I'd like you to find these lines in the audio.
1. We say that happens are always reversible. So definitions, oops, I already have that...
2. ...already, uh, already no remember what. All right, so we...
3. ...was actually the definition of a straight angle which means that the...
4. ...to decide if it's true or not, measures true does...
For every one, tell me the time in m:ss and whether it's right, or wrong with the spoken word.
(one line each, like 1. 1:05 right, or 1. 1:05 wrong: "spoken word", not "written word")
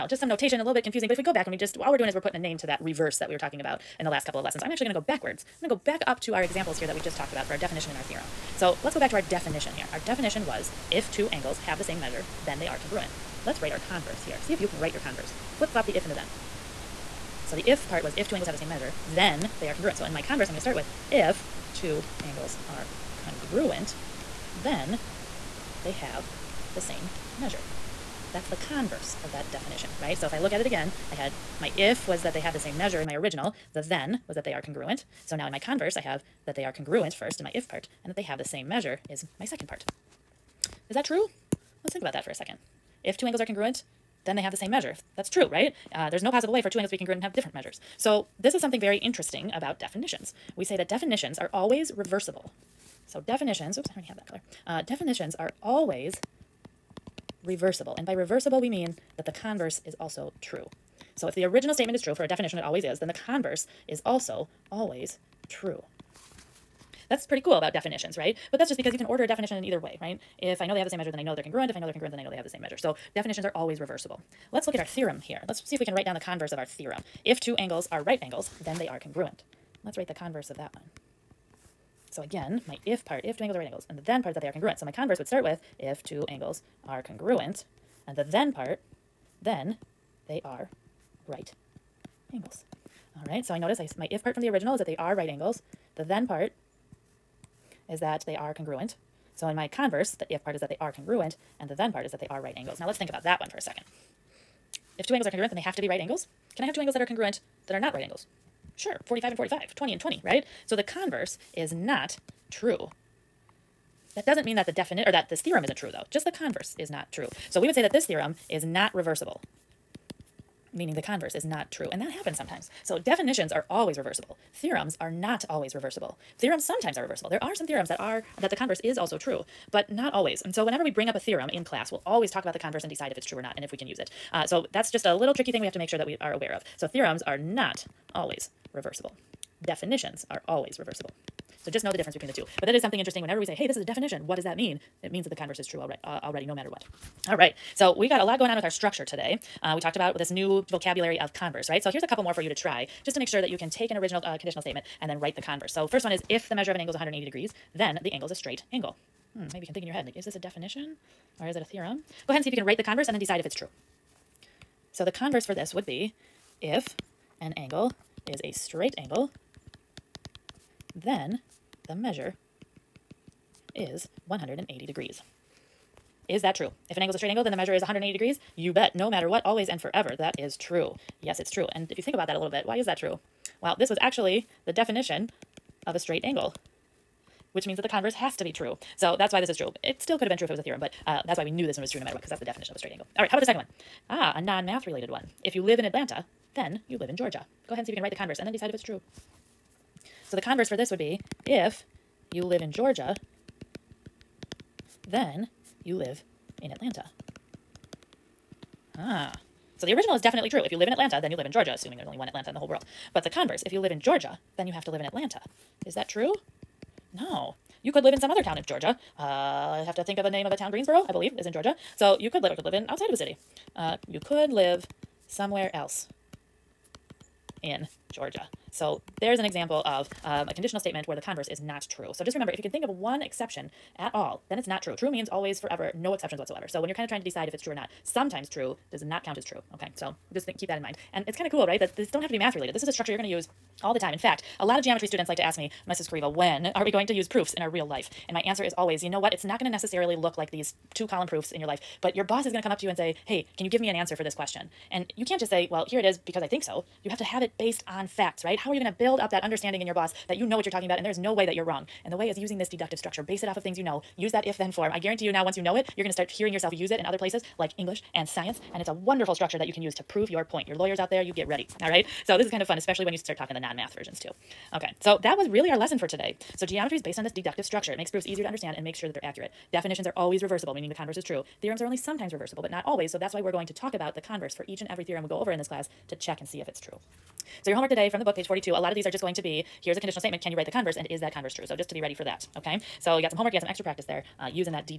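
1. 0:50 wrong: "definitions", not "happens"
2. 2:25 wrong: "matter", not "remember"
3. 3:03 right
4. 3:57 wrong: "sometimes", not "measures".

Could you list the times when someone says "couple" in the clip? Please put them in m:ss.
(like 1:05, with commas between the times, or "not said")
0:04, 2:32.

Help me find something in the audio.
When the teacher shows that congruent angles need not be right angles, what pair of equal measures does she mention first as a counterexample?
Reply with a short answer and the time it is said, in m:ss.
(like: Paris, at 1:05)
45 and 45, at 1:49.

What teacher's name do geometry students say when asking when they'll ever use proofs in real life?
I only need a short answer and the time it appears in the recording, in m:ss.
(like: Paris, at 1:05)
Mrs. Corriveau, at 4:05.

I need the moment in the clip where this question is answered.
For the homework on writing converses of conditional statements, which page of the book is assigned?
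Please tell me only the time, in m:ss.
4:48.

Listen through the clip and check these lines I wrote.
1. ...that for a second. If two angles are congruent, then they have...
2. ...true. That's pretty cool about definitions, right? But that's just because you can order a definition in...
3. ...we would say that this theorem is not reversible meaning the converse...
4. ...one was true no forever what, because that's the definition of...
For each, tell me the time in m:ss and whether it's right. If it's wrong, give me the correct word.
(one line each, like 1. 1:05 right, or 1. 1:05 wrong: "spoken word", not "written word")
1. 0:42 right
2. 1:05 right
3. 1:57 right
4. 3:11 wrong: "matter", not "forever".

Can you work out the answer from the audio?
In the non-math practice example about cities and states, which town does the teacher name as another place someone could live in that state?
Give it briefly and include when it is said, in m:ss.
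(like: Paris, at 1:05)
Greensboro, at 3:40.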